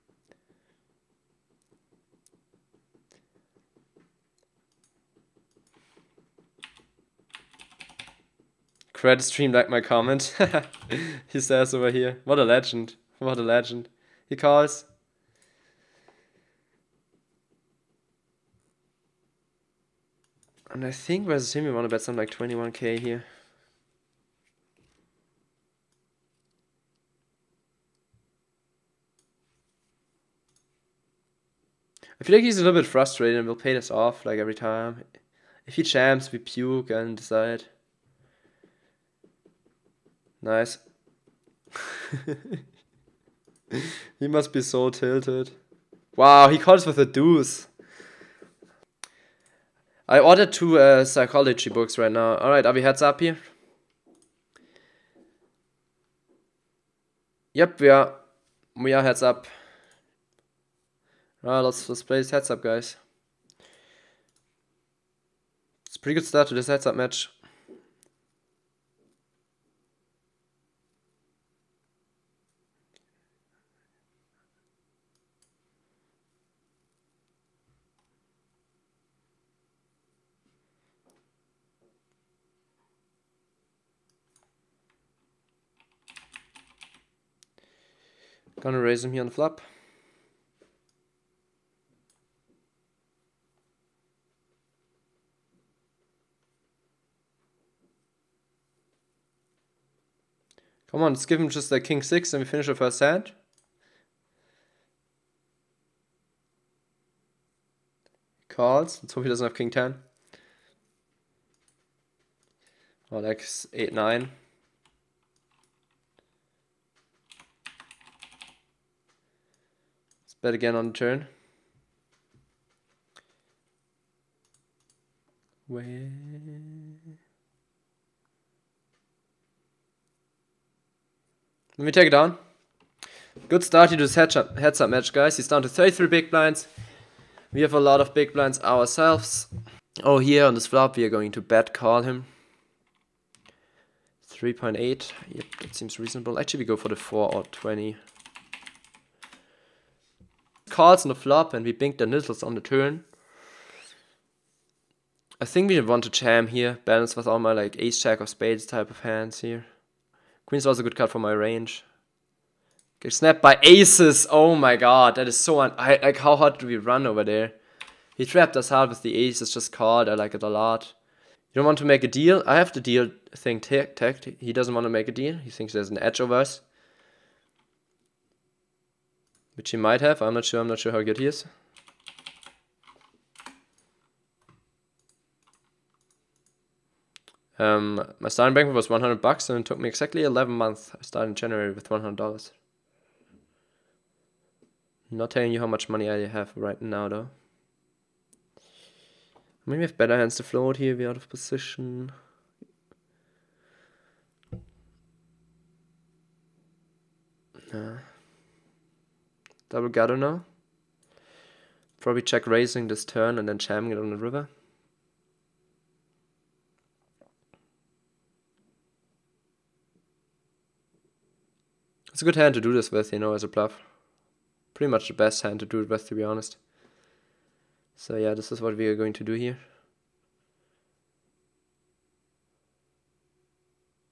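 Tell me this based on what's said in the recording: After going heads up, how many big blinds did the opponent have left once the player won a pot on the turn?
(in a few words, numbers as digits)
33.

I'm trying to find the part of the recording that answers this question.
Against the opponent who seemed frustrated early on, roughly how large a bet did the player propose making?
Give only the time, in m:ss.
0:22.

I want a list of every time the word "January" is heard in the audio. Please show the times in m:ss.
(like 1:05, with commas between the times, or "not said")
3:11.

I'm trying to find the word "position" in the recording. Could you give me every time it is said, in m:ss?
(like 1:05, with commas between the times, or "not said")
3:21.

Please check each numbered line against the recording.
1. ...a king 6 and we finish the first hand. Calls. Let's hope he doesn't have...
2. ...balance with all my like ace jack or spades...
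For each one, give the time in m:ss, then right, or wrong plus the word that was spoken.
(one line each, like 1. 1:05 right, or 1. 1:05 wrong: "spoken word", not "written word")
1. 1:41 right
2. 2:36 right.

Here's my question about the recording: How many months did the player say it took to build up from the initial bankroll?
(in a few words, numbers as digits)
11.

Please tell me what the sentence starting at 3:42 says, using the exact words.
It's a good hand to do this with, you know, as a bluff.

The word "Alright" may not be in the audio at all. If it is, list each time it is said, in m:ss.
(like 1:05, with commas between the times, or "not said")
0:52, 1:01.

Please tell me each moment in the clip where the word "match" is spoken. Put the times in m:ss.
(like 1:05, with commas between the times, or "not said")
1:06, 2:14.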